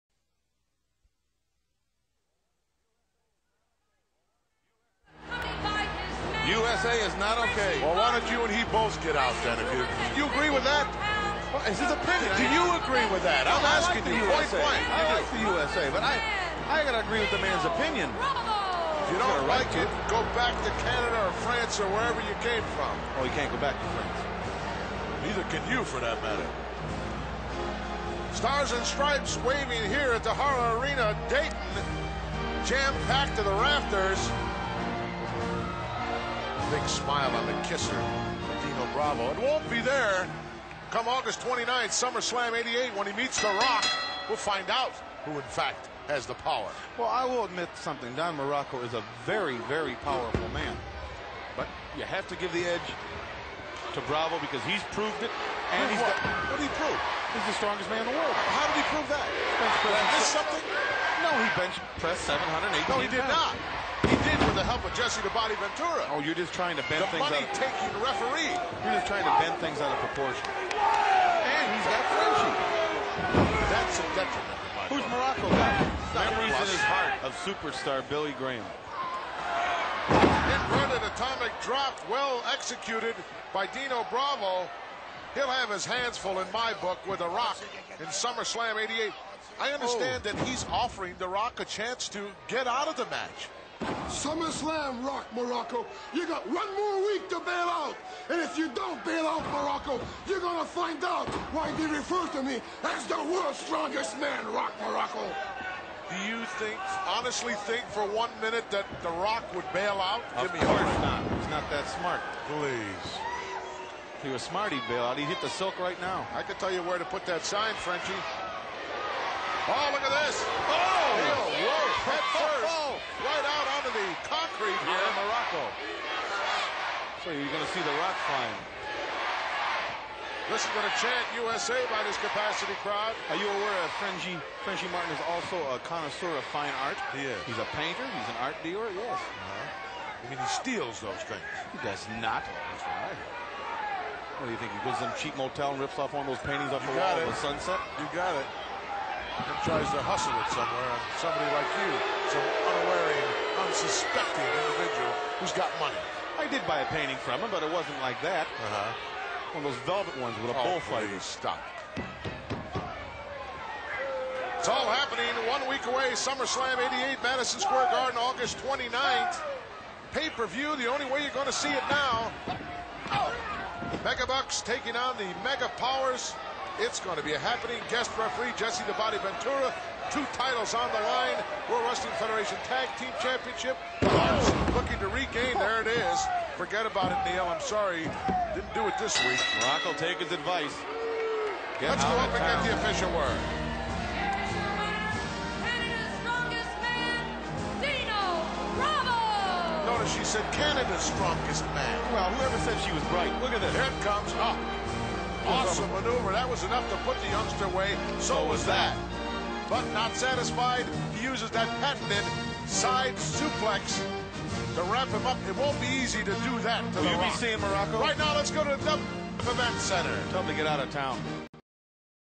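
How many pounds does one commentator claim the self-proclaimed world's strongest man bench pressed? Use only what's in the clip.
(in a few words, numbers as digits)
780.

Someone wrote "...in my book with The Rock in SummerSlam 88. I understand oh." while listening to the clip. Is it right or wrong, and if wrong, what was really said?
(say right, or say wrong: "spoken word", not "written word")
right.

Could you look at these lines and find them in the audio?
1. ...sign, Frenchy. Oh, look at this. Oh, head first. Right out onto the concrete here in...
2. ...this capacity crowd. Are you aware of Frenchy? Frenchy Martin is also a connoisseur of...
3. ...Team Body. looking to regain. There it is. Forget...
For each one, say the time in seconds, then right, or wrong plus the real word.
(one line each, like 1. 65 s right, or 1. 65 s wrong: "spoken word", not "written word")
1. 117 s right
2. 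132 s right
3. 182 s wrong: "Championship", not "Body".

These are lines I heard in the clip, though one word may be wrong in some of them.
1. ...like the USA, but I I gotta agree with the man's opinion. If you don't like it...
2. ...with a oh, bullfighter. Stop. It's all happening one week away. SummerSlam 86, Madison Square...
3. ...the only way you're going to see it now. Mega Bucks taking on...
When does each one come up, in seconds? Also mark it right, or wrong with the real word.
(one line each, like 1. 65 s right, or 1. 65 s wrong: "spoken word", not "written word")
1. 15 s right
2. 160 s wrong: "88", not "86"
3. 170 s right.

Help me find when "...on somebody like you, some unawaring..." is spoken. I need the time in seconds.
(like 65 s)
150 s.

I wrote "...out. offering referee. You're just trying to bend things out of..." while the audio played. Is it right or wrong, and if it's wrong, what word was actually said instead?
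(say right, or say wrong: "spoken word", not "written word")
wrong: "taking", not "offering".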